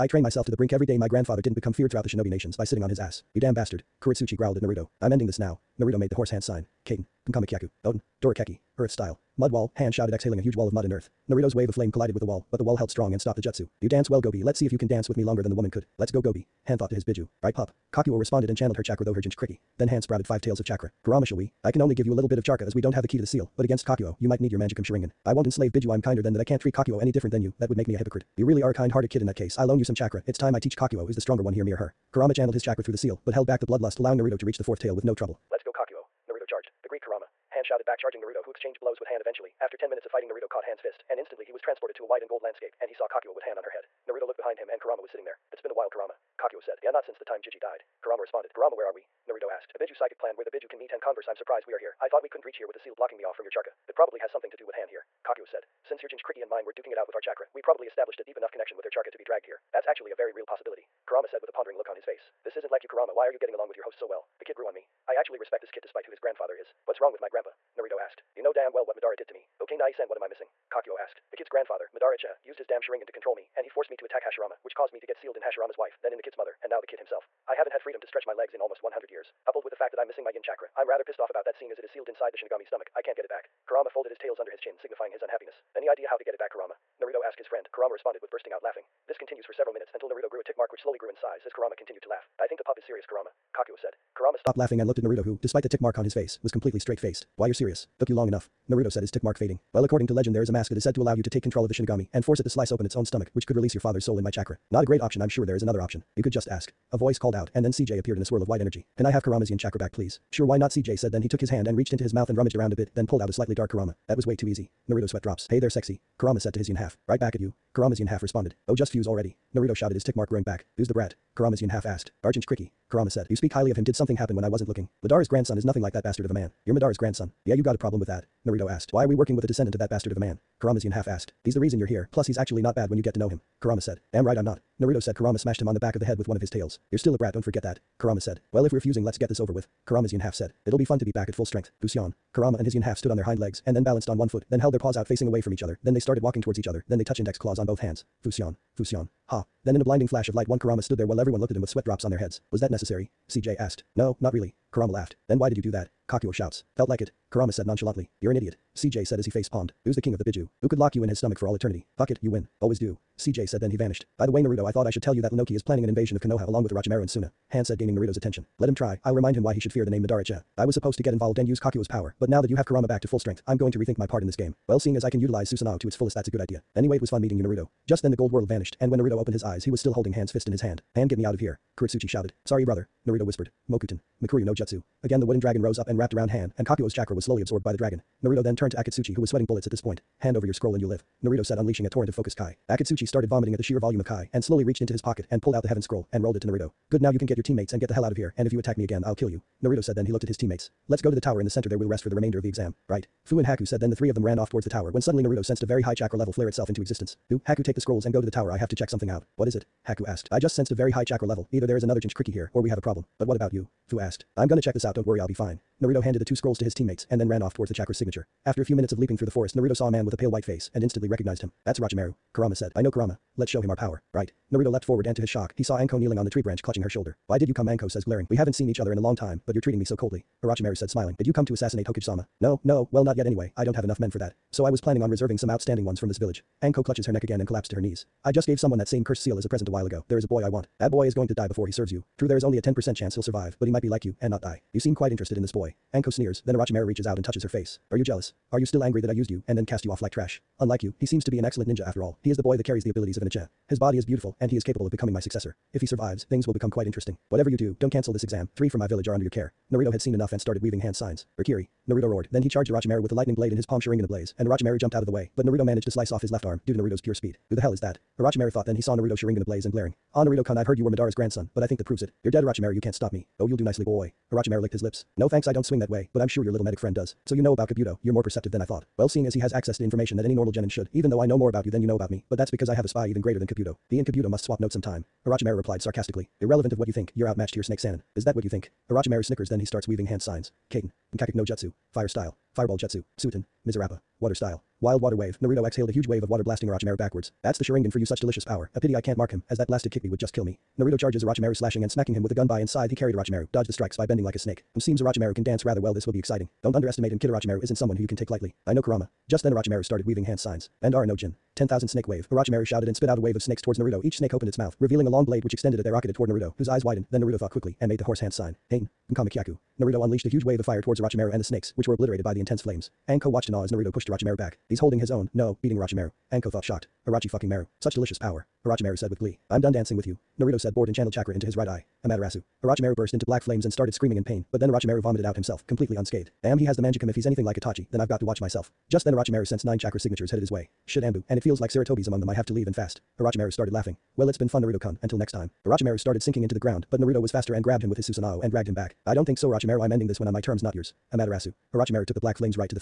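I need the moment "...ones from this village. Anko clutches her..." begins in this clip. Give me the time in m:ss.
3:55.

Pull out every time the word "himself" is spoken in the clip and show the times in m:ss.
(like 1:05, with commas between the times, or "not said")
1:16, 5:35.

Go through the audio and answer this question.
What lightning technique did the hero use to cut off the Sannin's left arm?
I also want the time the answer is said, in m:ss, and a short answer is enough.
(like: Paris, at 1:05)
Raikiri, at 4:21.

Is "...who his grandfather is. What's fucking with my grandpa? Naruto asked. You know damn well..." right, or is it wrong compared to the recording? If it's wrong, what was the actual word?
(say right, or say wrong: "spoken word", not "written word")
wrong: "wrong", not "fucking".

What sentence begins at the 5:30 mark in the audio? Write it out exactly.
Naruto said bored and channeled chakra into his right eye.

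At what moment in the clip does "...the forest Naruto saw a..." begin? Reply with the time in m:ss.
3:39.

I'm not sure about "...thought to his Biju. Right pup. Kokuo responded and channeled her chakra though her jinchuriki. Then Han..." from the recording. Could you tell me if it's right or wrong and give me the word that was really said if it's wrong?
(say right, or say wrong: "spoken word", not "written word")
right.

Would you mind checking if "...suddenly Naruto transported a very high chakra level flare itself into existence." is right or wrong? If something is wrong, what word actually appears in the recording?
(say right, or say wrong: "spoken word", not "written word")
wrong: "sensed", not "transported".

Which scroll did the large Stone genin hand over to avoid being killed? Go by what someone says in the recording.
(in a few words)
heaven scroll.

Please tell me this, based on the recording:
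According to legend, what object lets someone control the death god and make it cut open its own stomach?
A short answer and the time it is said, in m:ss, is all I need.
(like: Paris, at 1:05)
a mask, at 1:40.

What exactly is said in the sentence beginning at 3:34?
I'm gonna check this out don't worry I'll be fine.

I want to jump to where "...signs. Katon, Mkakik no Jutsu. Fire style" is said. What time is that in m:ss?
4:50.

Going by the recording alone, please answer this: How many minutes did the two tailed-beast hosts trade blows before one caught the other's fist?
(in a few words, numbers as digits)
10.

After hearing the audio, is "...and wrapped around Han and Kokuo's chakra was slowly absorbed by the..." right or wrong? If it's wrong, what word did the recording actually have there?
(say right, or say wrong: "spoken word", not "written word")
right.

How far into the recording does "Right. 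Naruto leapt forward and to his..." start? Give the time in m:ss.
3:44.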